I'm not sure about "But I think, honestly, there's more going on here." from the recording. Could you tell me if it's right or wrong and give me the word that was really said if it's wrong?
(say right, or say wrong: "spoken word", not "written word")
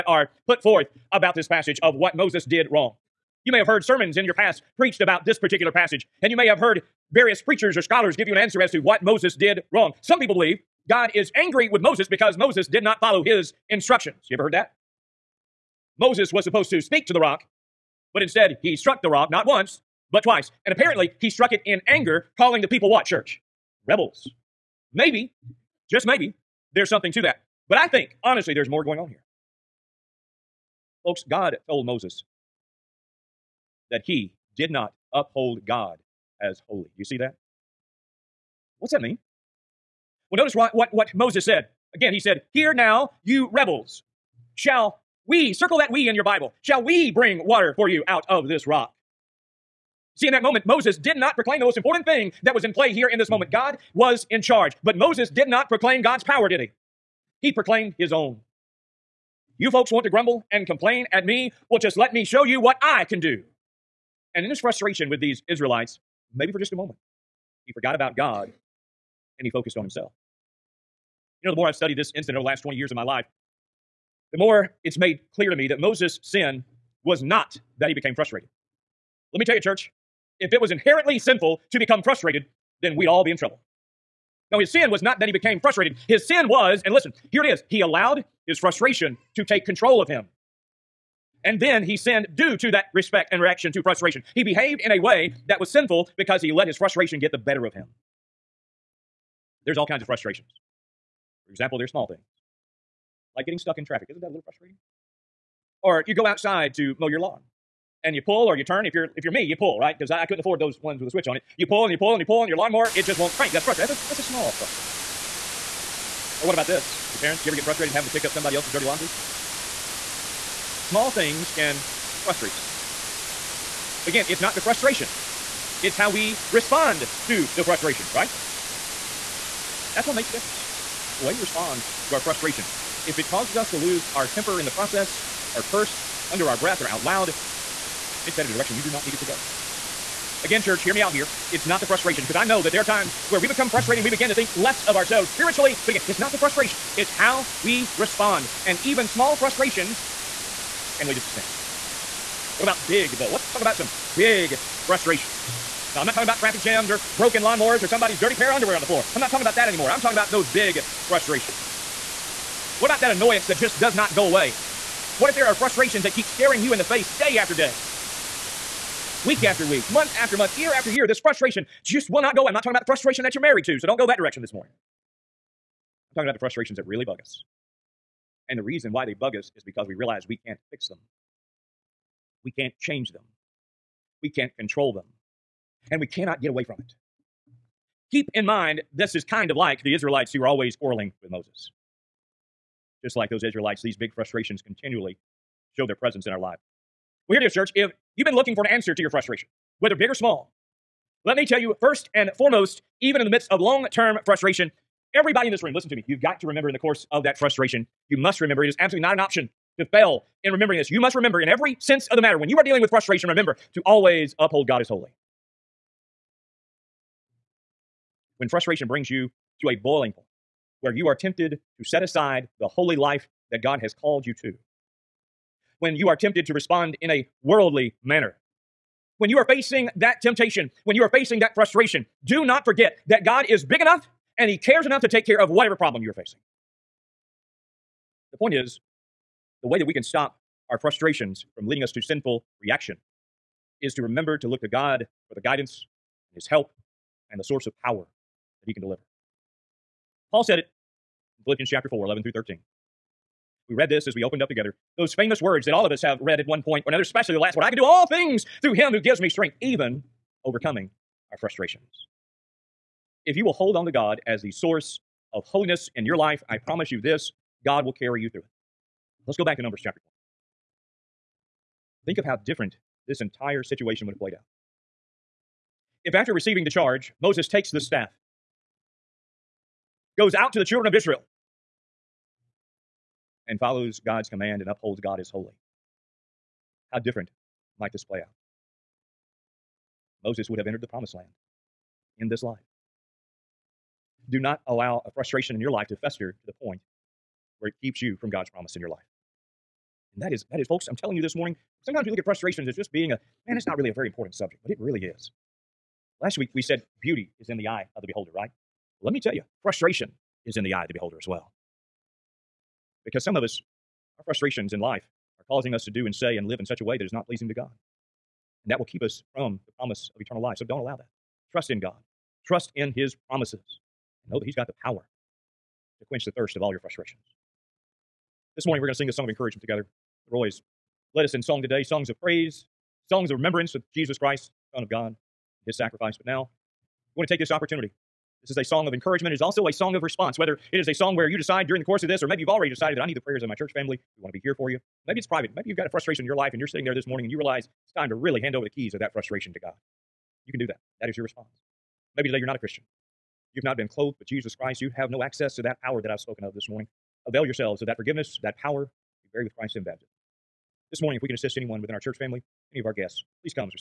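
right.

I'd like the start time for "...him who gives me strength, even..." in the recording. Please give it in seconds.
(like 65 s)
258 s.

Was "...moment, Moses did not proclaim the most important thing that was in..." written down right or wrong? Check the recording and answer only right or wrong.
right.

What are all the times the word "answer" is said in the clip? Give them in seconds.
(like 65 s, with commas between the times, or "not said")
8 s, 198 s.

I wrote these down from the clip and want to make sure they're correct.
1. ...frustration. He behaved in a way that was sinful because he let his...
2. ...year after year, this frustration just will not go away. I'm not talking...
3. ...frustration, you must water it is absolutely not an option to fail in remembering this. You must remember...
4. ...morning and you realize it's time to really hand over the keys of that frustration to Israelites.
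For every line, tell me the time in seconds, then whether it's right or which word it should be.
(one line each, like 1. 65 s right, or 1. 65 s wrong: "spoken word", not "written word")
1. 93 s right
2. 170 s right
3. 207 s wrong: "remember", not "water"
4. 347 s wrong: "God", not "Israelites".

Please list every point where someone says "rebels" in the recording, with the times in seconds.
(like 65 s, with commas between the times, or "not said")
23 s, 43 s.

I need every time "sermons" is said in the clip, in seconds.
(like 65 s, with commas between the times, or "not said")
3 s.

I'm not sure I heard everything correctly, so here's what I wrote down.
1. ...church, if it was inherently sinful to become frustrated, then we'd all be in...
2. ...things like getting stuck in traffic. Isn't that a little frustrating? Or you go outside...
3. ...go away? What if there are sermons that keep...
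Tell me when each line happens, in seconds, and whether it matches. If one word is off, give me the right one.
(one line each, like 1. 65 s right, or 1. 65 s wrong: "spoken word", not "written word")
1. 79 s right
2. 102 s right
3. 164 s wrong: "frustrations", not "sermons".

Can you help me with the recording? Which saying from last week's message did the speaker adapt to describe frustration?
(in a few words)
Beauty is in the eye of the beholder.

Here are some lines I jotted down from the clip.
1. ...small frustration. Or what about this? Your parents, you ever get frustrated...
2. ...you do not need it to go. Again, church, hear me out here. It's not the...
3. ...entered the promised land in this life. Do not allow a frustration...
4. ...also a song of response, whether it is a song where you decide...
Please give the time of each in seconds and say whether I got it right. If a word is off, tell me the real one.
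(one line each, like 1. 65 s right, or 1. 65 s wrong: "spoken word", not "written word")
1. 114 s right
2. 138 s right
3. 290 s right
4. 339 s right.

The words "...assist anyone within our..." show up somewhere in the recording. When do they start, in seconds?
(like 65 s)
361 s.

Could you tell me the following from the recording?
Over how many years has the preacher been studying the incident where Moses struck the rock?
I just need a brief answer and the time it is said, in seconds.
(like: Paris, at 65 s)
20, at 72 s.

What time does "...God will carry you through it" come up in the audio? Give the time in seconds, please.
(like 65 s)
267 s.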